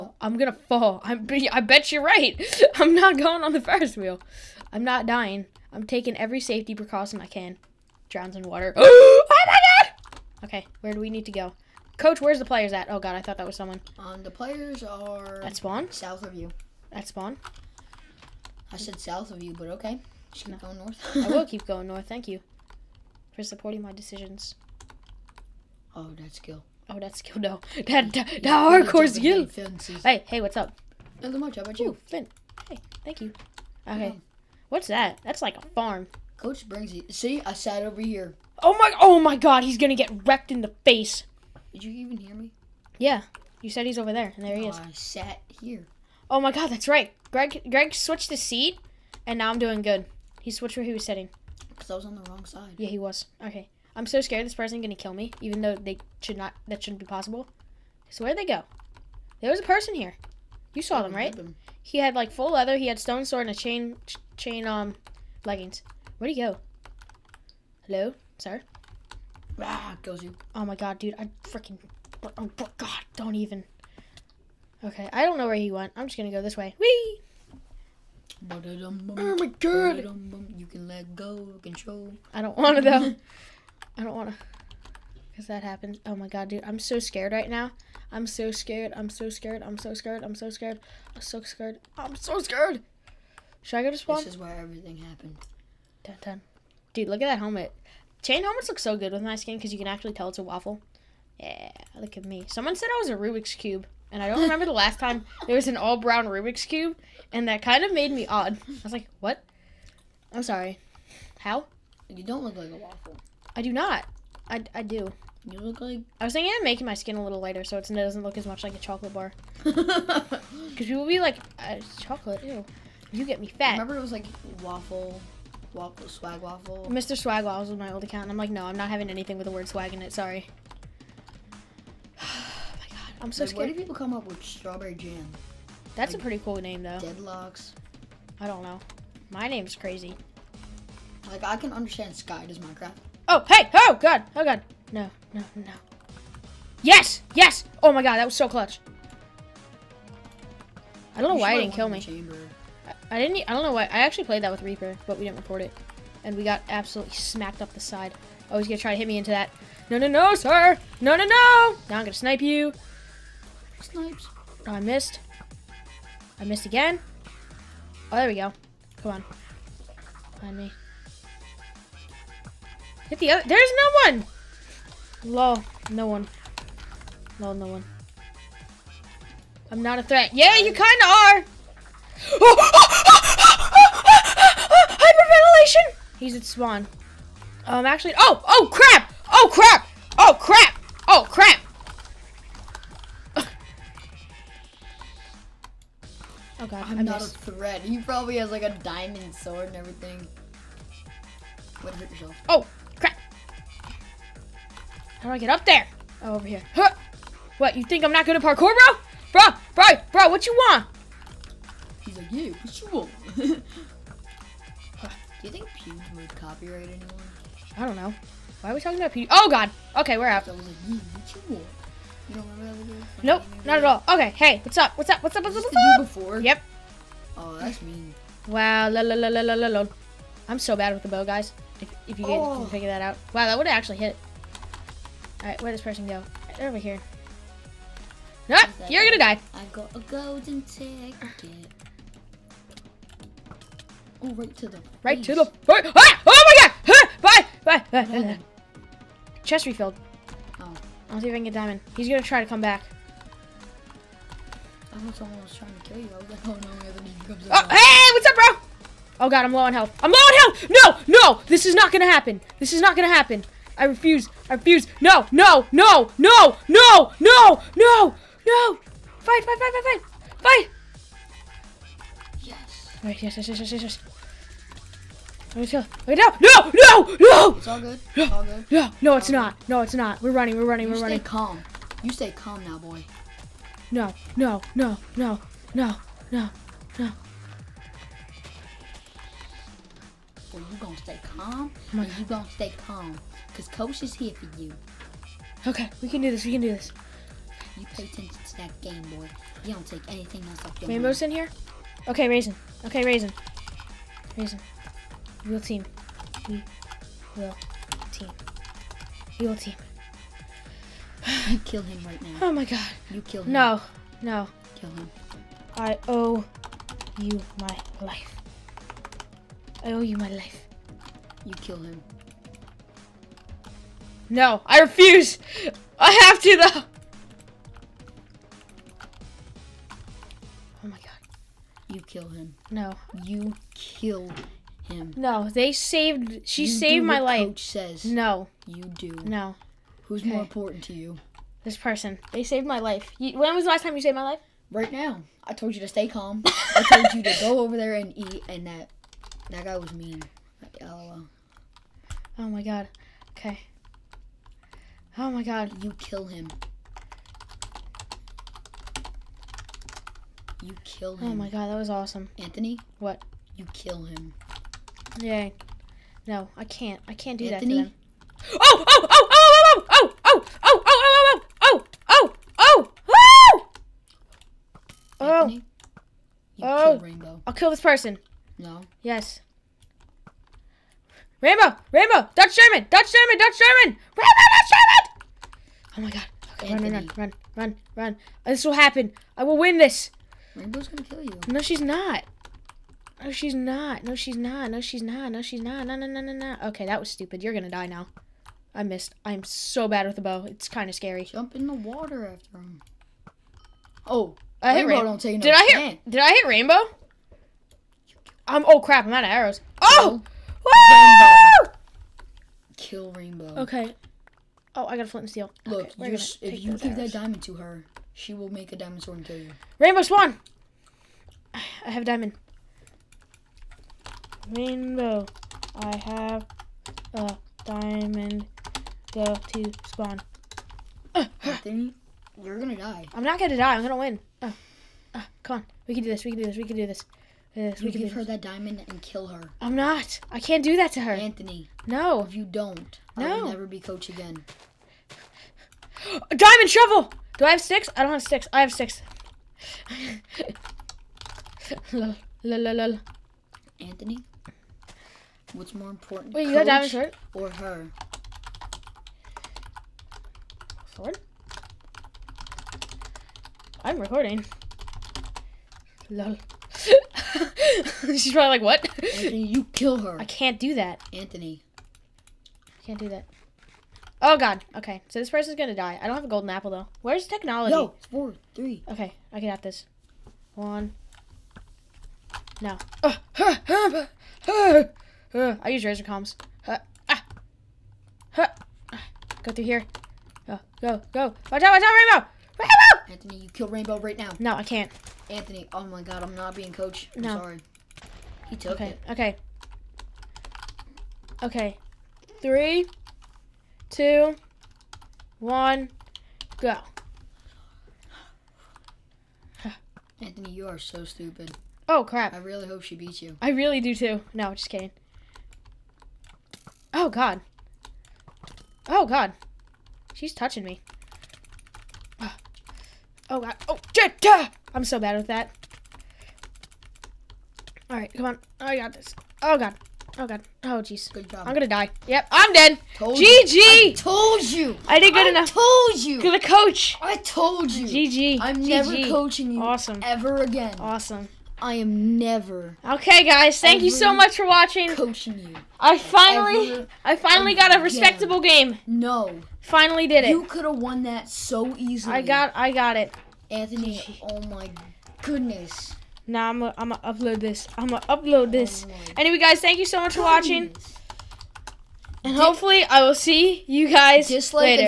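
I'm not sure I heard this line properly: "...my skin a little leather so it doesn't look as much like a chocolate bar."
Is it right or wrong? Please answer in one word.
wrong.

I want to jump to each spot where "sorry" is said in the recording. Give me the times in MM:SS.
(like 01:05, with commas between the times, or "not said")
01:50, 02:10, 08:17.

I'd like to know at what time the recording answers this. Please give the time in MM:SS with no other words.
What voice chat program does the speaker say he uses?
08:05.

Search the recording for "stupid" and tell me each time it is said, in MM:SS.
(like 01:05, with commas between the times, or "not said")
06:37, 08:31.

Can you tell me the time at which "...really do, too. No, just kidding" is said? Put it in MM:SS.
08:33.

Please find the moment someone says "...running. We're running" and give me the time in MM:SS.
04:40.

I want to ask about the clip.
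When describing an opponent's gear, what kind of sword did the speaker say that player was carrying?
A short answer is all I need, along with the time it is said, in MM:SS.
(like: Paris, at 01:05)
stone sword, at 01:02.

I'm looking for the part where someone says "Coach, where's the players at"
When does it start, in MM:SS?
00:11.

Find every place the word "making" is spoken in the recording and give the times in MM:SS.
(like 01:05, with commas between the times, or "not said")
01:56.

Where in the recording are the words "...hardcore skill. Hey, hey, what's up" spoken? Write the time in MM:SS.
00:28.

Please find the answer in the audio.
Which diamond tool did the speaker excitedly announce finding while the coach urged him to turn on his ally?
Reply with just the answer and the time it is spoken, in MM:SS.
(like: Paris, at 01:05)
diamond shovel, at 07:26.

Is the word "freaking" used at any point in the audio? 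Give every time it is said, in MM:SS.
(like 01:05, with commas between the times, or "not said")
01:11.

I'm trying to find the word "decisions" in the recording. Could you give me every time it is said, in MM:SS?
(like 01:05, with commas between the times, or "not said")
00:23.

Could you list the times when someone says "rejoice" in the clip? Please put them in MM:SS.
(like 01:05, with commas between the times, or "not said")
not said.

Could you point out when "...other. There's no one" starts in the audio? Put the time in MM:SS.
02:53.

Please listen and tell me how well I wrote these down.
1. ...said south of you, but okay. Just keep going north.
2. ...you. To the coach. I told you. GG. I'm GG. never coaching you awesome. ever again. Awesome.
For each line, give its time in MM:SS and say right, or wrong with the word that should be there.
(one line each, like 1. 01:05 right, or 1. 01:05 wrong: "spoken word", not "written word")
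1. 00:18 right
2. 08:56 right.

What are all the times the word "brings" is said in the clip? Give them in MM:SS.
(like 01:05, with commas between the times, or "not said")
00:36.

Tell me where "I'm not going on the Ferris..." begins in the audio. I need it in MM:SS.
00:02.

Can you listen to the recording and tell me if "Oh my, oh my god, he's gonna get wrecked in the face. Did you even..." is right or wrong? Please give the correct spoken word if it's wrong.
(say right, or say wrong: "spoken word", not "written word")
right.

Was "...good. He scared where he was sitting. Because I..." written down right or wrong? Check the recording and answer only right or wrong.
wrong.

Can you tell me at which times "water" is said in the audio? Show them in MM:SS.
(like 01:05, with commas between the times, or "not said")
00:08, 06:41.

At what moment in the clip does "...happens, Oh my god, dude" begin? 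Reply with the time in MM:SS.
01:25.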